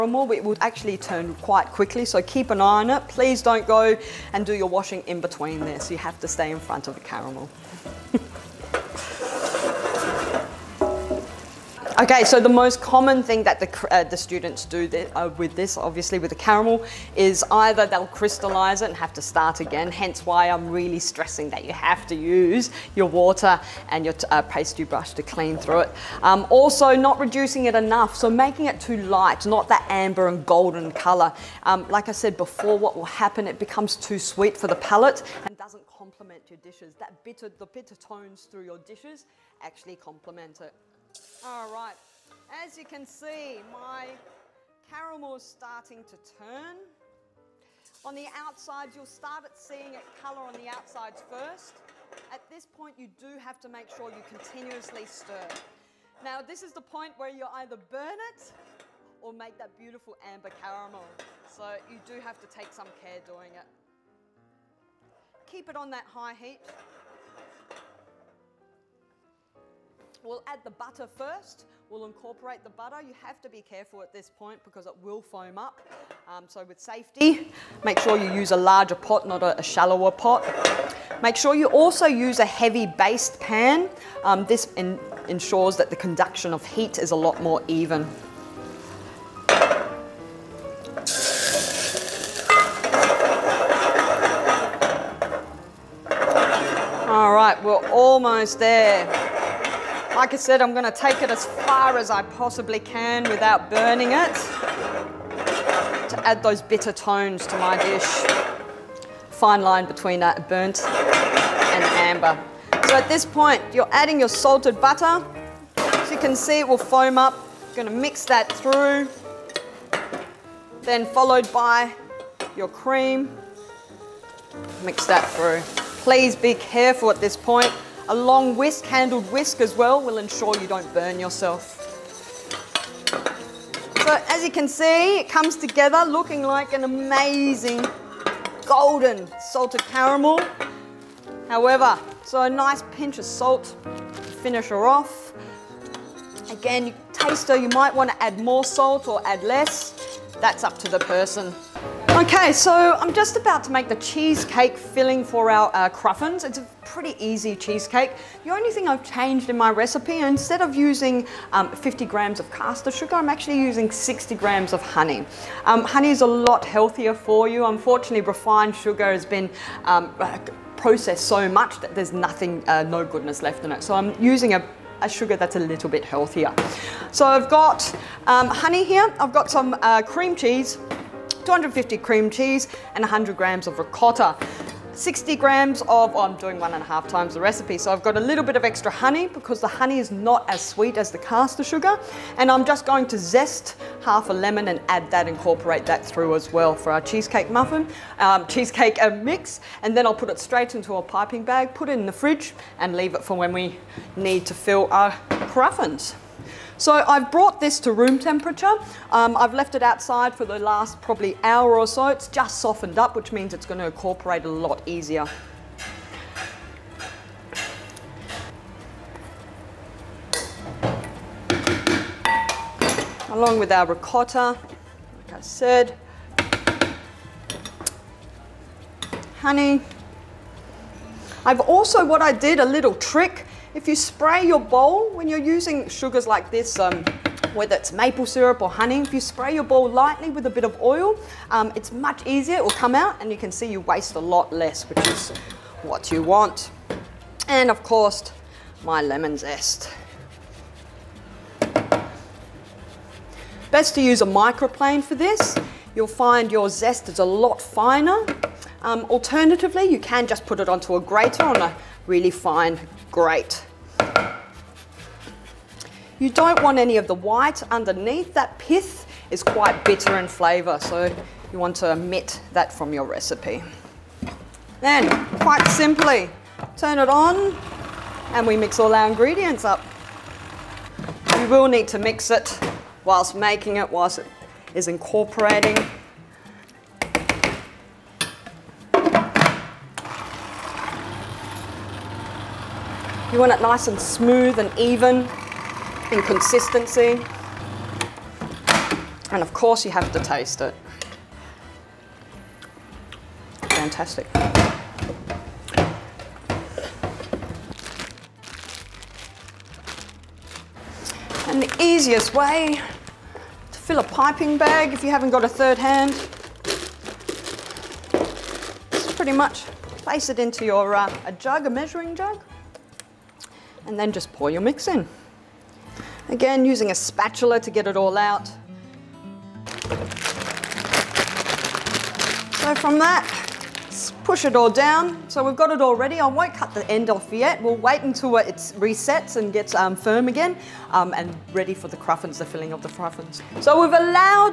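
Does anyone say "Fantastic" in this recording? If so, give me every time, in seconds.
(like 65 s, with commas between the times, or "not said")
303 s.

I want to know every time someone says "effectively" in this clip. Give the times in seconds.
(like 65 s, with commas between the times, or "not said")
not said.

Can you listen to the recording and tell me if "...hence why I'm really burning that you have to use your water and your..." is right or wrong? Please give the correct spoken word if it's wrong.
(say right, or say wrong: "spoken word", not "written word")
wrong: "stressing", not "burning".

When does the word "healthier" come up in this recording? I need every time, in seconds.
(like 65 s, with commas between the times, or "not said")
166 s, 176 s.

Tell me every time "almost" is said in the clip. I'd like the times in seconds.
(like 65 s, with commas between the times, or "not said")
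97 s.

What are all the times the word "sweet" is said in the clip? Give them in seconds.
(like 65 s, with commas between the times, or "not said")
34 s, 190 s.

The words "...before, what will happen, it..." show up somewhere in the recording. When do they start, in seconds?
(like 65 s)
32 s.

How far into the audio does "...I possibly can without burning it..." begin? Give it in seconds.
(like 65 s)
102 s.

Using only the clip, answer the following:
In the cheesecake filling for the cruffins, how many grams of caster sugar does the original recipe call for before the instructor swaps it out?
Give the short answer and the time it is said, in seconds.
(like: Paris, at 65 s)
50 grams, at 161 s.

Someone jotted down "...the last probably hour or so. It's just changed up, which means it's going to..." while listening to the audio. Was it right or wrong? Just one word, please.
wrong.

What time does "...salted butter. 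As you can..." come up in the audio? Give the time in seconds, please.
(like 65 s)
114 s.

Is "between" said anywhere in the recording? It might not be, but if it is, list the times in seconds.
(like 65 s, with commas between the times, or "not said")
5 s, 109 s.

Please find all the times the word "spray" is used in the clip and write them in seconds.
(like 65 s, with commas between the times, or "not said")
233 s, 239 s.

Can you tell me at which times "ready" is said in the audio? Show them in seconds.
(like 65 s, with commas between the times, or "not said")
335 s, 341 s.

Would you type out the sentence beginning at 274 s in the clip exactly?
Then, quite simply, turn it on and we mix all our ingredients up.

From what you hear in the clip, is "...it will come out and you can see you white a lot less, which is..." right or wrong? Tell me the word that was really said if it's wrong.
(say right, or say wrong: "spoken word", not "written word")
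wrong: "waste", not "white".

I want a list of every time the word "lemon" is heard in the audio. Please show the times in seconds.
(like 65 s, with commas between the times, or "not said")
194 s, 249 s.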